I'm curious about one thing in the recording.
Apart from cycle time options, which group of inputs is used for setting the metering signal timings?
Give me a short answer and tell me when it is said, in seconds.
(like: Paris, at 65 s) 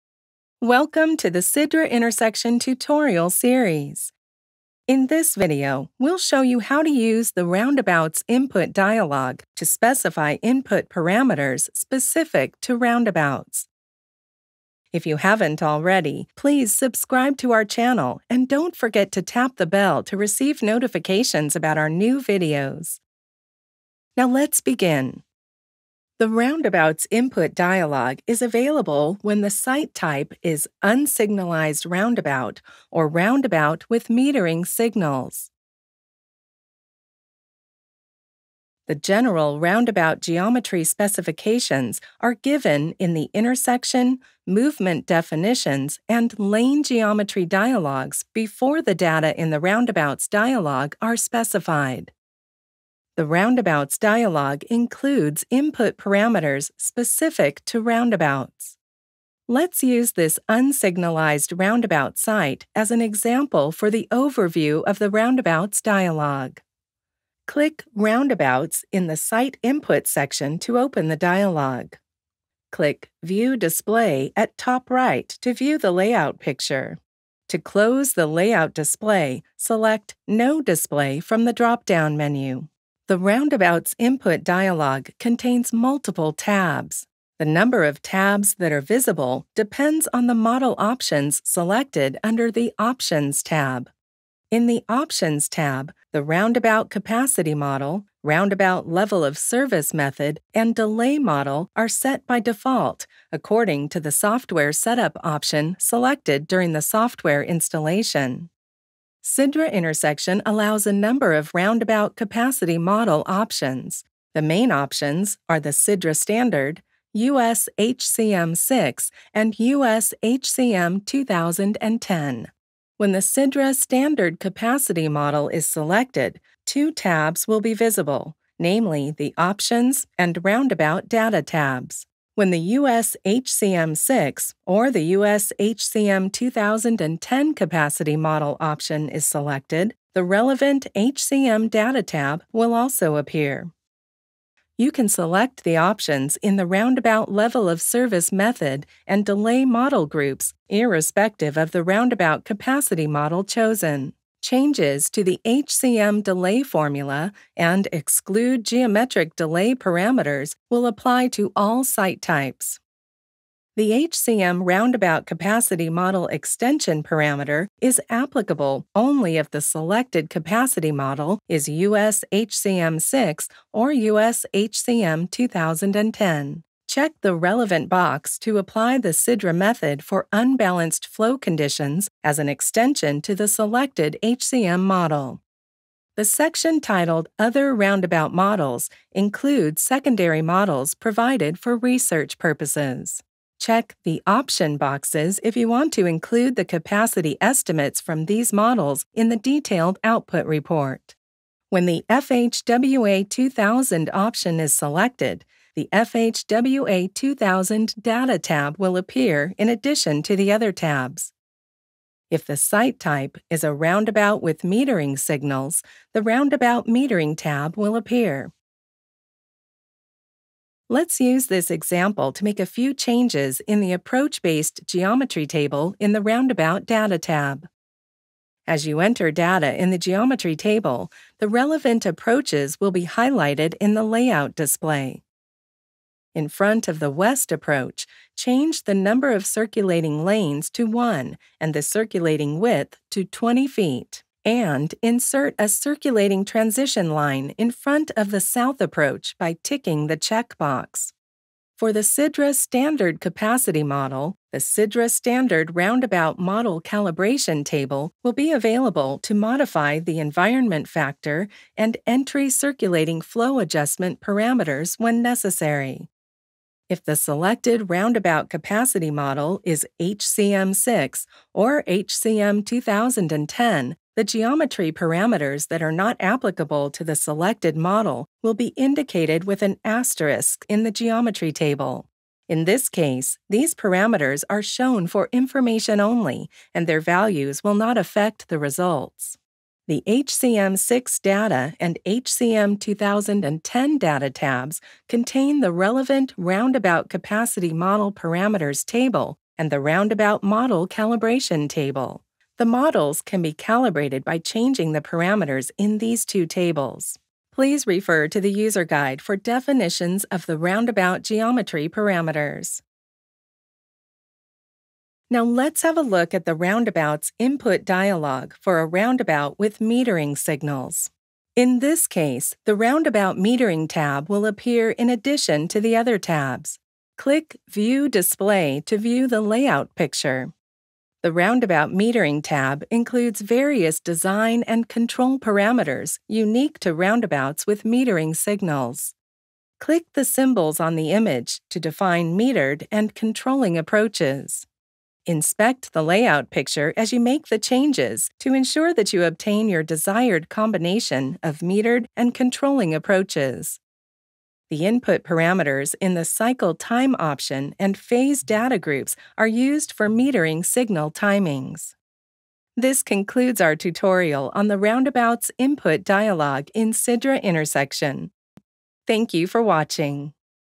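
phase data, at 357 s.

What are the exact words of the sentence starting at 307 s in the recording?
Please refer to the user guide for definitions of the roundabout geometry parameters.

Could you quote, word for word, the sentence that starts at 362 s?
This concludes our tutorial on the roundabout's input dialog in Sidra intersection.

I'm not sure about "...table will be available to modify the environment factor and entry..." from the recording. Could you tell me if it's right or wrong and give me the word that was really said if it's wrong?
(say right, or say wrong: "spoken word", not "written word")
right.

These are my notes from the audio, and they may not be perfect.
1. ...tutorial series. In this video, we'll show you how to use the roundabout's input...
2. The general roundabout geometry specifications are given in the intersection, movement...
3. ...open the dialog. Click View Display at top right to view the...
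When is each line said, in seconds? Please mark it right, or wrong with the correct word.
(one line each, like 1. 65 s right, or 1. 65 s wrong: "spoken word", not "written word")
1. 2 s right
2. 38 s right
3. 70 s right.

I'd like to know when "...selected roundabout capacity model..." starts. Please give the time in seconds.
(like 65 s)
267 s.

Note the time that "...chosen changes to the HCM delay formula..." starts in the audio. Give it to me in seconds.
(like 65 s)
153 s.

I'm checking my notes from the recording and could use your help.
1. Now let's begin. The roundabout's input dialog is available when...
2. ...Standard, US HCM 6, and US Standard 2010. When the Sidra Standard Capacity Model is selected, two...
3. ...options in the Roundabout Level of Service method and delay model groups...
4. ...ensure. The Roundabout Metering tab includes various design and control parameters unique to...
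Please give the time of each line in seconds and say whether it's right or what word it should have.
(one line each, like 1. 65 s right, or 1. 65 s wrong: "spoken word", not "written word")
1. 24 s right
2. 116 s wrong: "HCM", not "Standard"
3. 145 s right
4. 329 s wrong: "picture", not "ensure".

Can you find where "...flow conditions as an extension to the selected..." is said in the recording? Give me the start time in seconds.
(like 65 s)
181 s.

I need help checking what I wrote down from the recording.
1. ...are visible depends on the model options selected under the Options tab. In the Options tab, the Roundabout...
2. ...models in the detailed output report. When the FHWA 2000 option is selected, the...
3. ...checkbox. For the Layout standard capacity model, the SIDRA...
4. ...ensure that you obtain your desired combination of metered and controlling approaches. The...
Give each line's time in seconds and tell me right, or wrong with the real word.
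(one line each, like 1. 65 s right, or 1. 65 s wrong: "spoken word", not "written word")
1. 88 s right
2. 198 s right
3. 250 s wrong: "SIDRA", not "Layout"
4. 348 s right.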